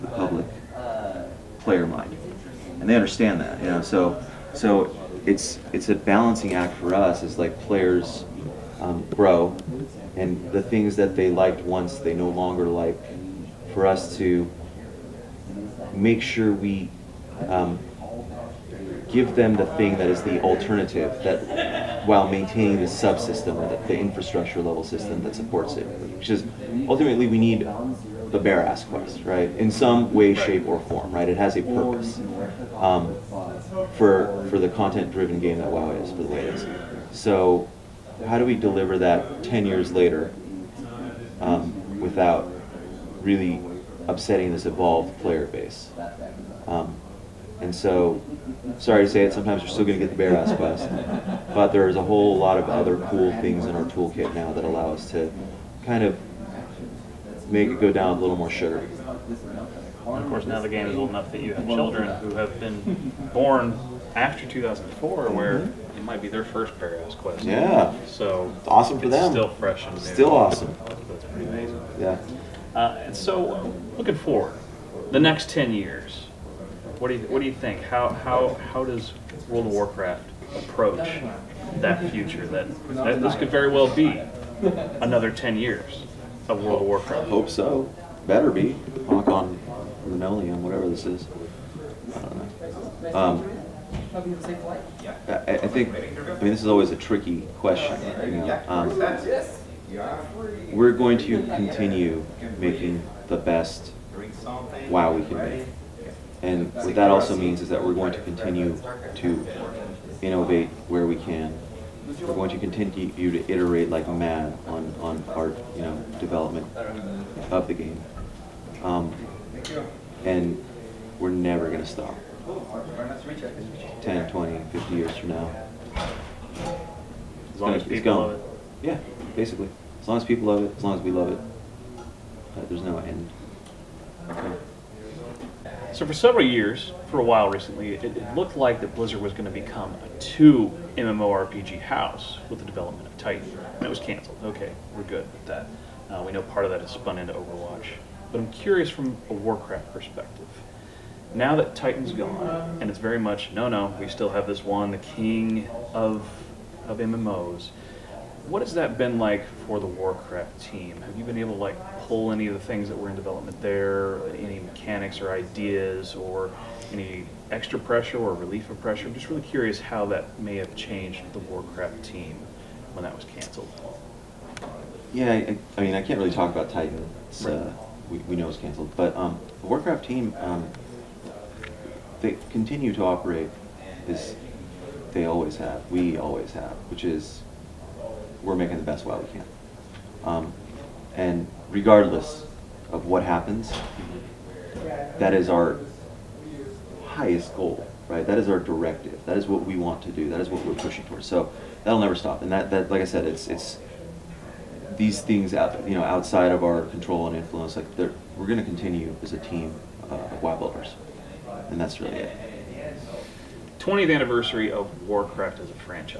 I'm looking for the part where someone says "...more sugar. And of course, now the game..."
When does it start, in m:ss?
0:58.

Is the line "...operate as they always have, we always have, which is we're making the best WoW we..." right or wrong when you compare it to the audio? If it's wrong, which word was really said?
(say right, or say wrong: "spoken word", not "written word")
right.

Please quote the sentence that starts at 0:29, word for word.
In some way, shape, or form, right?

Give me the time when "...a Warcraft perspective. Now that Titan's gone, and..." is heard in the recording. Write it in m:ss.
2:29.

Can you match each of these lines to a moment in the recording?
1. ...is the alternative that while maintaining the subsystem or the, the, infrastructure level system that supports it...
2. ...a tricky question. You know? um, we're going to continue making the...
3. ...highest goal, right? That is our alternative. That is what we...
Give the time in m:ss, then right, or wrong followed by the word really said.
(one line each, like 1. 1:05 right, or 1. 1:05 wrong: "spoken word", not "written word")
1. 0:20 right
2. 1:36 right
3. 3:17 wrong: "directive", not "alternative".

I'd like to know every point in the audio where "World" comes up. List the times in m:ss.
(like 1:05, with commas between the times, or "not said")
1:19, 1:26.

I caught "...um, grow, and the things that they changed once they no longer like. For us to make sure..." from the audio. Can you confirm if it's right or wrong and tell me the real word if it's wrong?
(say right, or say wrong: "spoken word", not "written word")
wrong: "liked", not "changed".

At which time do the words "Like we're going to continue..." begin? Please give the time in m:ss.
3:27.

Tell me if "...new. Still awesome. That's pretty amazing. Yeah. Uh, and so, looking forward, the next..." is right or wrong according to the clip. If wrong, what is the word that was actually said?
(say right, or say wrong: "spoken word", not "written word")
right.